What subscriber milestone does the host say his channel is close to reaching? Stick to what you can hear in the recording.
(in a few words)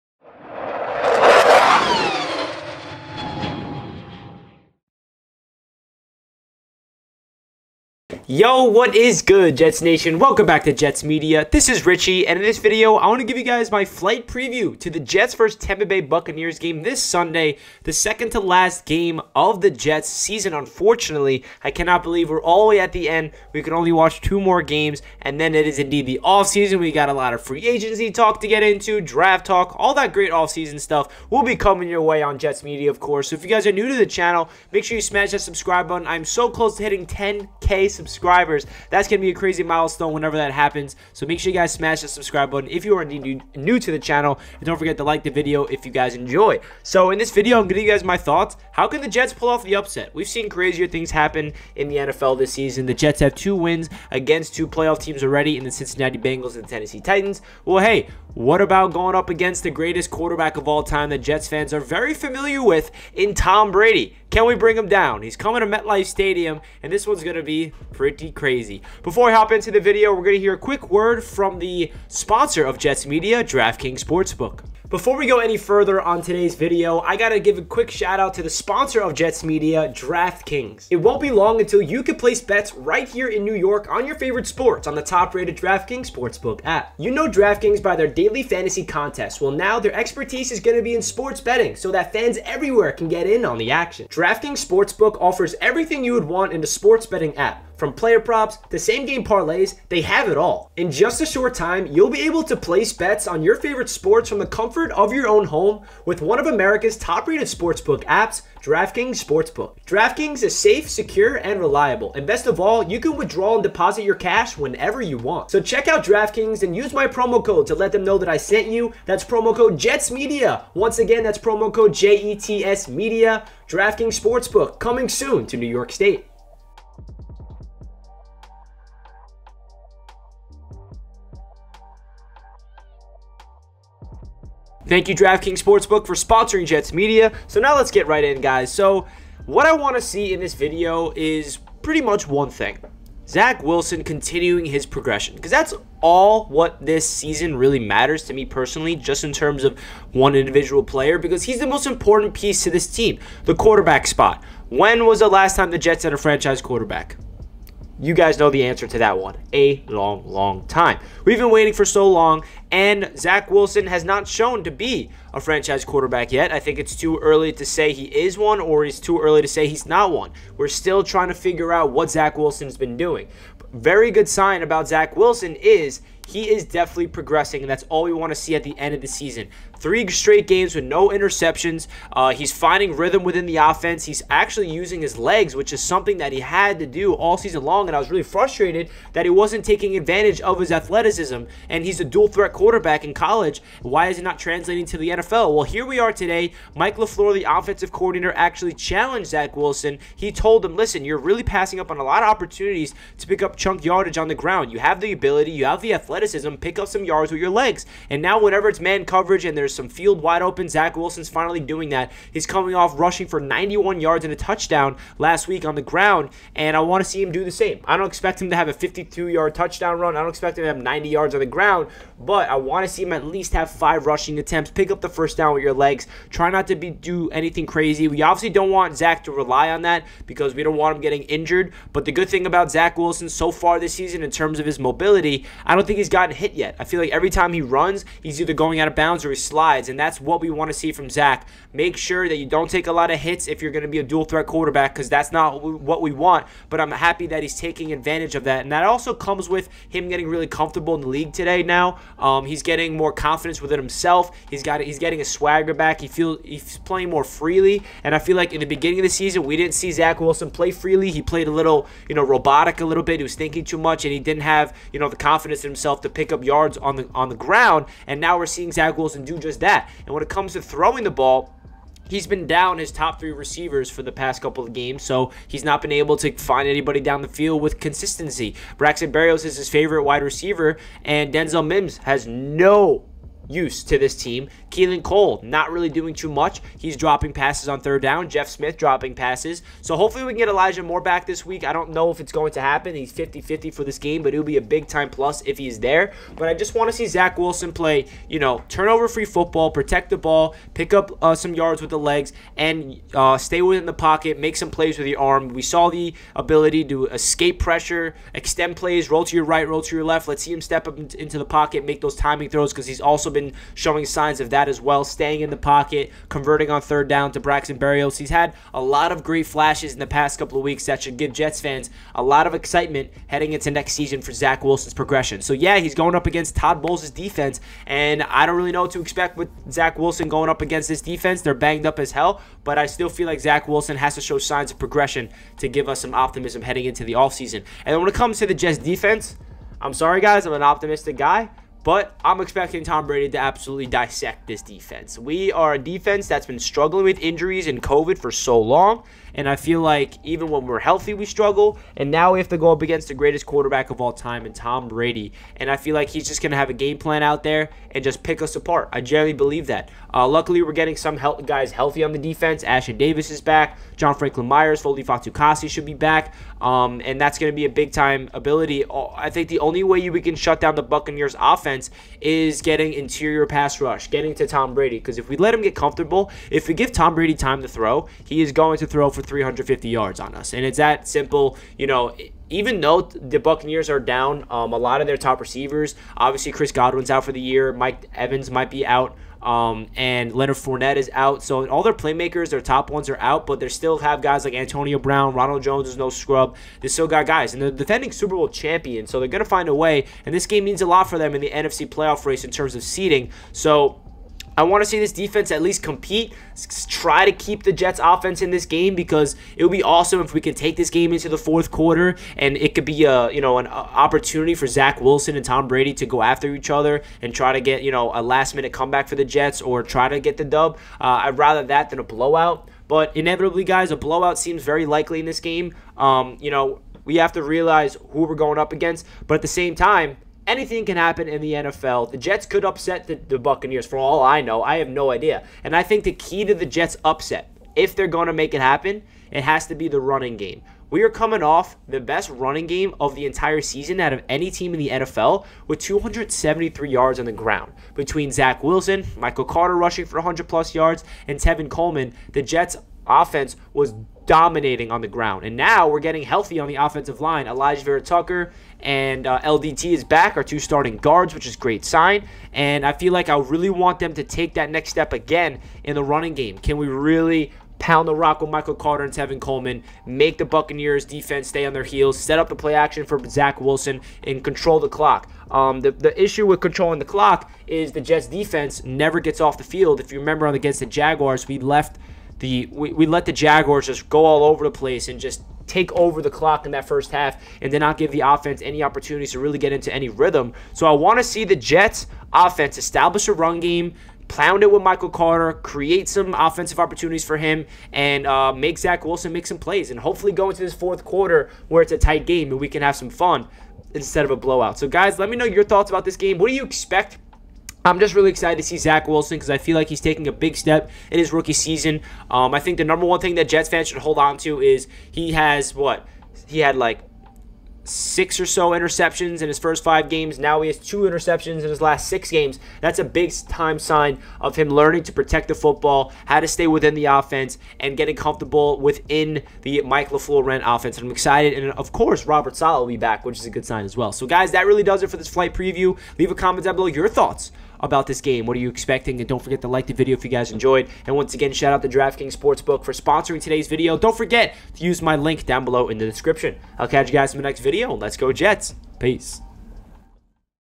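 10k.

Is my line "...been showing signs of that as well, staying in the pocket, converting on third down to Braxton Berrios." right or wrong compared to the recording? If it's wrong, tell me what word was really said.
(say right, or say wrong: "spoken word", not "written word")
right.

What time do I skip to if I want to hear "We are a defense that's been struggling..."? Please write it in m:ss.
5:45.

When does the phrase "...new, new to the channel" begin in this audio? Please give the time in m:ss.
0:43.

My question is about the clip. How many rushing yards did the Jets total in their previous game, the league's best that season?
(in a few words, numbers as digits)
273.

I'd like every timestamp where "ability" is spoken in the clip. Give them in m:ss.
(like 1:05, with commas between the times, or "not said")
3:25, 5:06, 6:08.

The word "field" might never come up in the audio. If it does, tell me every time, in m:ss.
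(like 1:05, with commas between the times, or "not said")
3:29, 4:37, 7:59.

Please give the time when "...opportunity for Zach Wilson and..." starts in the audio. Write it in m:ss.
6:53.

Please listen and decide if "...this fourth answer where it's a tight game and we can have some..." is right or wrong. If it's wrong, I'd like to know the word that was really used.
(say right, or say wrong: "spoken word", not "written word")
wrong: "quarter", not "answer".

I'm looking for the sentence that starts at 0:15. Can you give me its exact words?
Tampa Bay Buccaneers game this Sunday, the second to last game of the Jets season.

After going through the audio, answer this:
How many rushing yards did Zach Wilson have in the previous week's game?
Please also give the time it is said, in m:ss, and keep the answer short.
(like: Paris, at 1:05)
91, at 3:33.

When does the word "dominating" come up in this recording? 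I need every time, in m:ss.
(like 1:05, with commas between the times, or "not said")
7:34.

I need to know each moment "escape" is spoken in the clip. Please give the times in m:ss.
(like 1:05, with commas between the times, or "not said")
5:07.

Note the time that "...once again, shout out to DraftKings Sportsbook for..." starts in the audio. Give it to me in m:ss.
9:01.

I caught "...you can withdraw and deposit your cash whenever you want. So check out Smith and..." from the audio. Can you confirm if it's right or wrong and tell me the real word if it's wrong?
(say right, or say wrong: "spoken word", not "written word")
wrong: "DraftKings", not "Smith".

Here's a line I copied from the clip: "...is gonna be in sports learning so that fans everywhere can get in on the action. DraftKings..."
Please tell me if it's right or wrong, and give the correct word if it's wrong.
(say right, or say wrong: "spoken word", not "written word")
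wrong: "betting", not "learning".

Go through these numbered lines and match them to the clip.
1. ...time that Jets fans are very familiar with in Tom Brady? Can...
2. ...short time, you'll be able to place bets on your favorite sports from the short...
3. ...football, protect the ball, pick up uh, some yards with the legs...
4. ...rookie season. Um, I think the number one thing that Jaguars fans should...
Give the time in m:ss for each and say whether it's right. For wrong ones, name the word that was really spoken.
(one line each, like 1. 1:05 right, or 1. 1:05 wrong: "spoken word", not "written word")
1. 1:00 right
2. 1:41 wrong: "comfort", not "short"
3. 4:59 right
4. 8:31 wrong: "Jets", not "Jaguars".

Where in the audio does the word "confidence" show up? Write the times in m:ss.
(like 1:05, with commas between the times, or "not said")
4:13, 4:25.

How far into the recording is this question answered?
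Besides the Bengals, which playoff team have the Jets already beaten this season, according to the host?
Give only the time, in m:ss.
0:56.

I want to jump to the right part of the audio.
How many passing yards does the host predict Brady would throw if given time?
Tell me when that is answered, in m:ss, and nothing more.
6:19.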